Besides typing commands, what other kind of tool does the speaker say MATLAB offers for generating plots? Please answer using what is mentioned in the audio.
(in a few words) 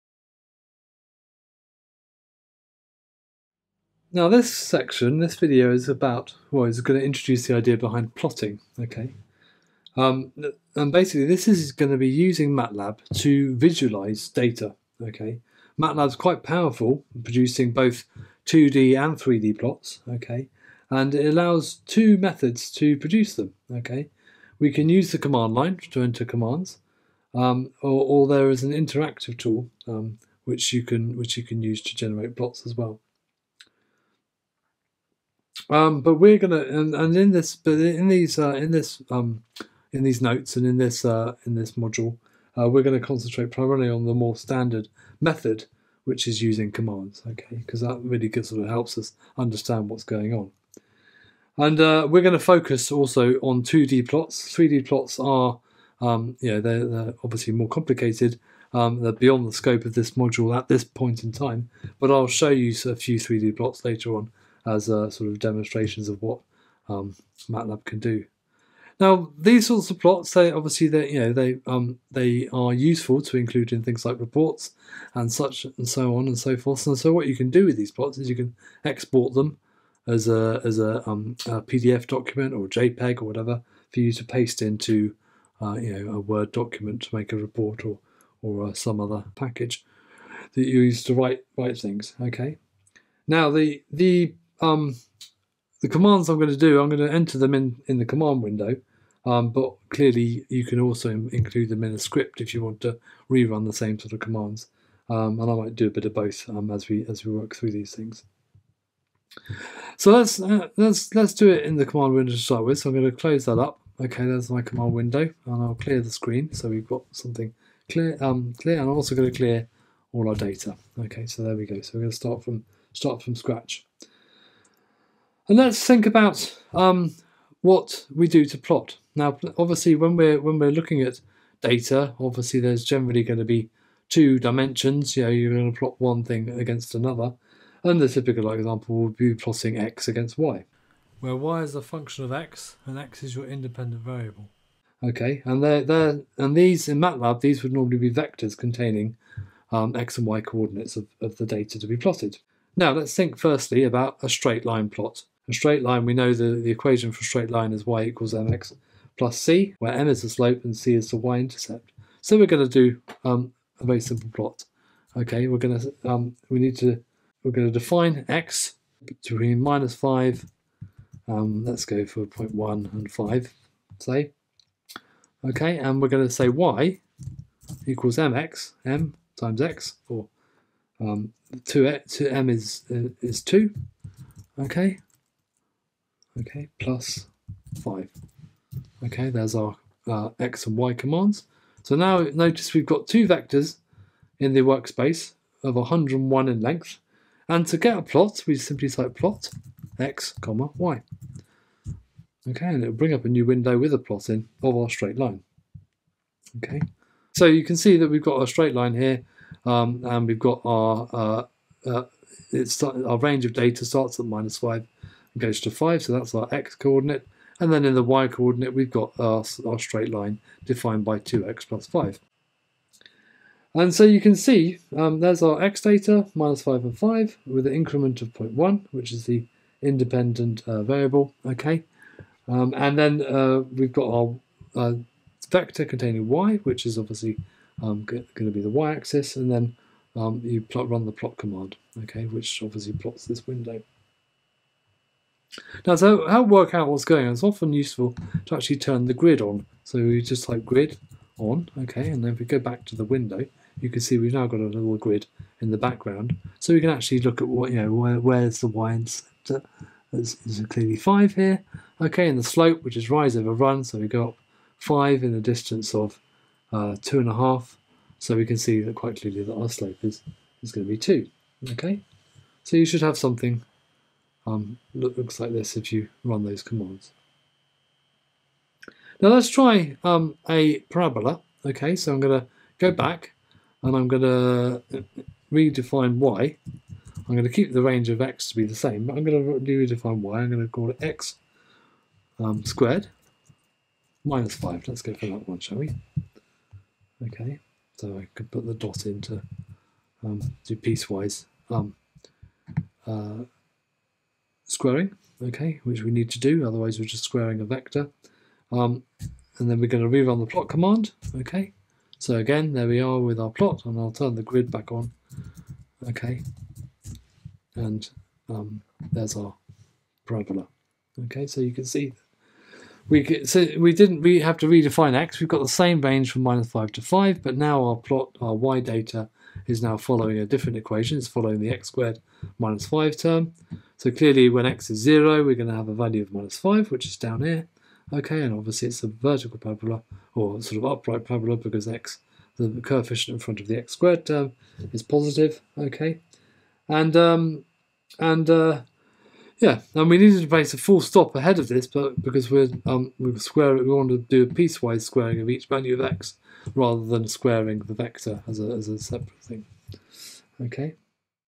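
interactive tool.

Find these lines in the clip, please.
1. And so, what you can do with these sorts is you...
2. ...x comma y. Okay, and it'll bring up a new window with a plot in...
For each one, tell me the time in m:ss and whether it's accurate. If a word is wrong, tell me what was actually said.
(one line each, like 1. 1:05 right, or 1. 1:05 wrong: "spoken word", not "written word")
1. 1:16 wrong: "plots", not "sorts"
2. 3:19 right.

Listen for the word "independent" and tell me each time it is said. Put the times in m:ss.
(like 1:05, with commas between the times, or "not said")
2:23, 3:49.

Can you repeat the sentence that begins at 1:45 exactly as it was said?
Um, and I might do a bit of both um, as we as we work through these things.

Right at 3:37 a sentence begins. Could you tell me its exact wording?
And then in the y coordinate, we've got our, our straight line defined by 2x plus 5.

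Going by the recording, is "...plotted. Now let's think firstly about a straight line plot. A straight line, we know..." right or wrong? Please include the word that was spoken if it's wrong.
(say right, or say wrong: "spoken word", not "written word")
right.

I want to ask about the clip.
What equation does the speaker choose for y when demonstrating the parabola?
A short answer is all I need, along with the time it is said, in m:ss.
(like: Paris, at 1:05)
x squared minus 5, at 4:51.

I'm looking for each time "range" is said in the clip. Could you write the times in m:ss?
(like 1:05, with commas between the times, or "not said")
3:33, 4:47, 5:26.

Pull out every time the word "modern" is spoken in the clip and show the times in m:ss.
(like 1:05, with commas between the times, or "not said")
not said.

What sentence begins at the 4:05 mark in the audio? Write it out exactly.
Now, to help work out what's going on, it's often useful to actually turn the grid on.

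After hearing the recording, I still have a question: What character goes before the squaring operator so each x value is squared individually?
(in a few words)
full stop.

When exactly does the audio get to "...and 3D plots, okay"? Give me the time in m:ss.
0:19.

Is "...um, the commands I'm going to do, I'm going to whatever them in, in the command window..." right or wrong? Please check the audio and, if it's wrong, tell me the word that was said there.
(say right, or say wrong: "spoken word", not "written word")
wrong: "enter", not "whatever".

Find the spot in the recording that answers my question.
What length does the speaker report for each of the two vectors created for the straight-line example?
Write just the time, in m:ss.
3:15.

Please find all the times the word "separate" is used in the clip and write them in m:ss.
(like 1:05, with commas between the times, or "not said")
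5:58.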